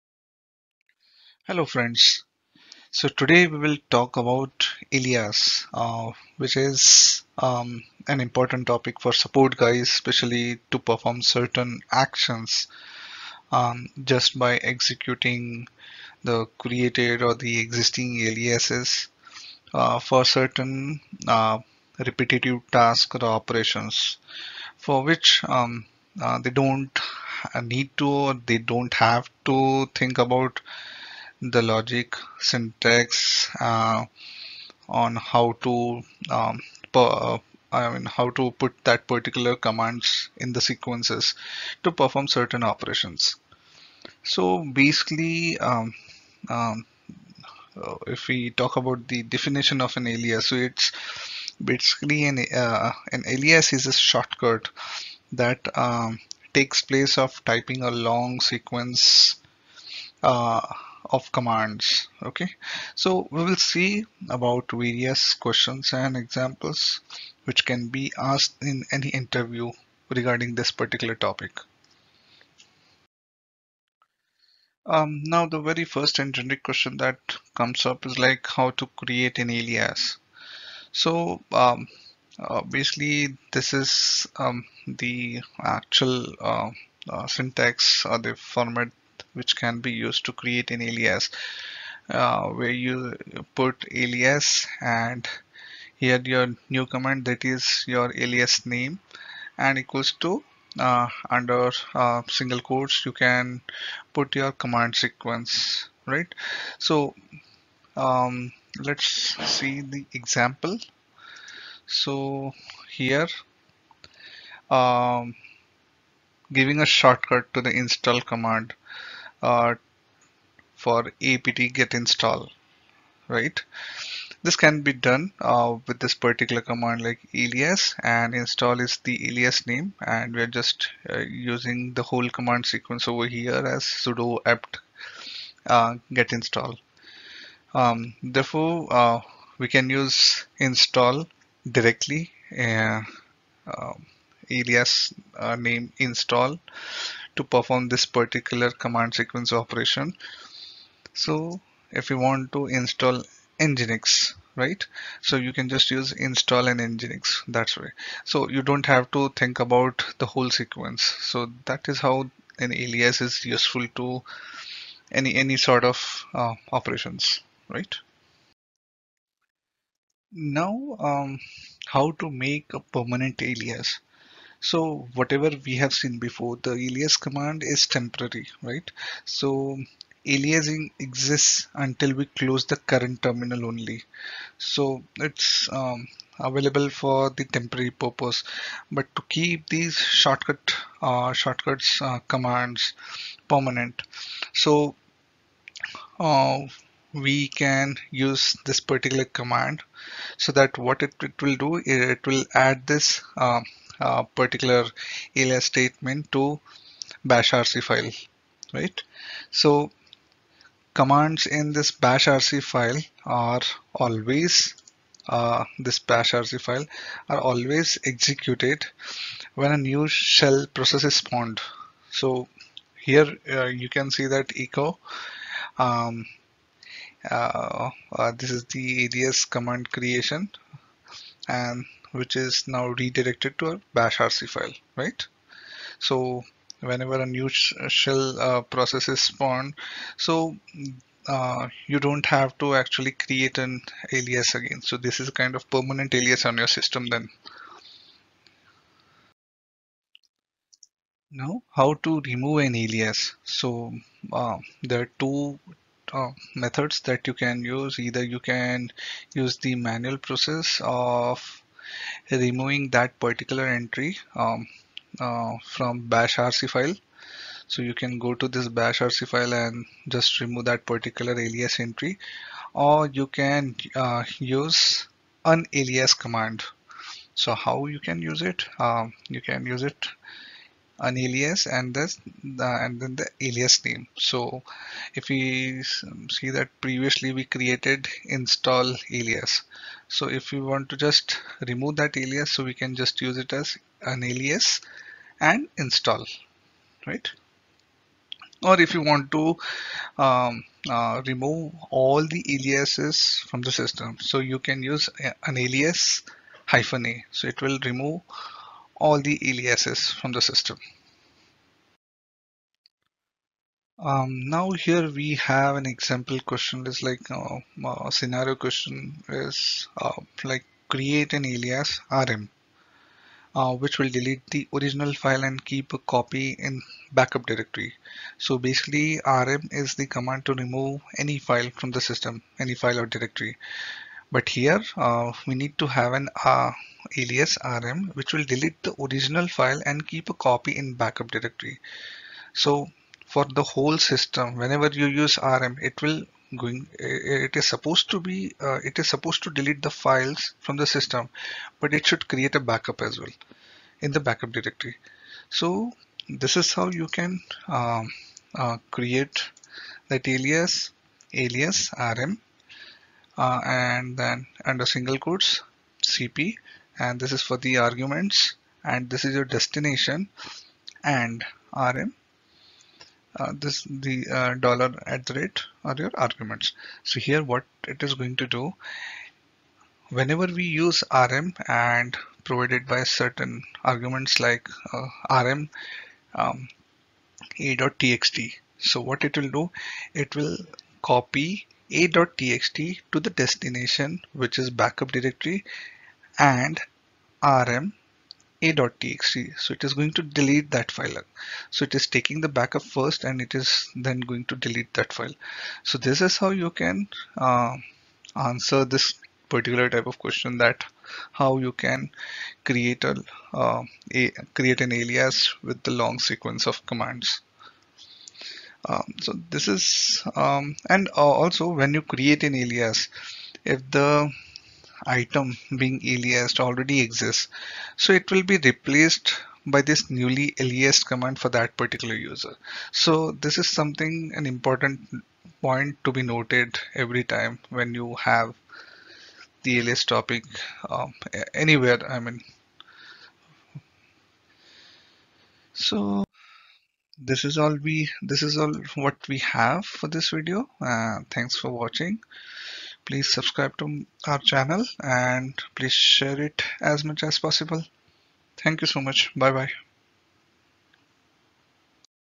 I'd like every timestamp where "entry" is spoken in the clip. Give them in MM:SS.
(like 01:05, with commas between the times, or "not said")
04:23, 04:31.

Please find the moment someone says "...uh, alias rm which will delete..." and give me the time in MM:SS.
05:36.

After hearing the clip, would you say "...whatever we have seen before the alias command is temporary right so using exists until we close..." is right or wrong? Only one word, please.
wrong.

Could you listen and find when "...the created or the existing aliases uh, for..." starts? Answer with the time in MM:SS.
00:16.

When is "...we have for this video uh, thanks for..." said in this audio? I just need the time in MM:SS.
07:29.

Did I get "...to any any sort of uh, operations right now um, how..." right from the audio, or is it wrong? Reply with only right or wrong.
right.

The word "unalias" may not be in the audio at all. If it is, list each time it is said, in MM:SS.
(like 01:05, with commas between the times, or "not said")
04:35, 04:41, 04:54, 05:05.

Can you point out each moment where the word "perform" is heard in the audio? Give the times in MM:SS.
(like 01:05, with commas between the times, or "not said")
00:10, 00:41, 02:27.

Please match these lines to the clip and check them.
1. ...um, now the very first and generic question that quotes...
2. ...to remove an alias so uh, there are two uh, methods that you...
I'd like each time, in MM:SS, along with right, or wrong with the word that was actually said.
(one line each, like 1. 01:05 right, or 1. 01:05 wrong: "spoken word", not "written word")
1. 01:14 wrong: "comes", not "quotes"
2. 04:12 right.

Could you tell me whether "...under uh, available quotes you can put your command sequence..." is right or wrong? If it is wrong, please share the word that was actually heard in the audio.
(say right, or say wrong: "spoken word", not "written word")
wrong: "single", not "available".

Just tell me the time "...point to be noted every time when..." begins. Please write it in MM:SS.
07:15.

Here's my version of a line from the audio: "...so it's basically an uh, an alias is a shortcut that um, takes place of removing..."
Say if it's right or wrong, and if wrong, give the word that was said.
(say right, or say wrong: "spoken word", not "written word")
wrong: "typing", not "removing".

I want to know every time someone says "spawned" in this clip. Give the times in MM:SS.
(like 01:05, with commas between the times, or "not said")
03:41, 03:59.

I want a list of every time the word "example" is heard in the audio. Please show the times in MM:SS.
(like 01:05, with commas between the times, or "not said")
01:06, 01:50, 05:15.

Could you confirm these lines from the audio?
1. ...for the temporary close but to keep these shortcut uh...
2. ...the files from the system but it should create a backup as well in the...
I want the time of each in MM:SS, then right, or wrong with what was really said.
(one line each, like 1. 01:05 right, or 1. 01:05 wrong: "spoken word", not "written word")
1. 03:06 wrong: "purpose", not "close"
2. 05:49 right.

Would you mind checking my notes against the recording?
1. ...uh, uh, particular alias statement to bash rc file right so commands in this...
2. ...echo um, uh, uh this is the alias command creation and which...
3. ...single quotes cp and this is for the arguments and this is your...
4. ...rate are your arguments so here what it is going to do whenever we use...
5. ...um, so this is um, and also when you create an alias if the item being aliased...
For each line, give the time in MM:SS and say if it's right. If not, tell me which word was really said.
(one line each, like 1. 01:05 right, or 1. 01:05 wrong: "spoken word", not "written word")
1. 03:23 right
2. 03:44 right
3. 06:04 right
4. 06:15 right
5. 06:58 right.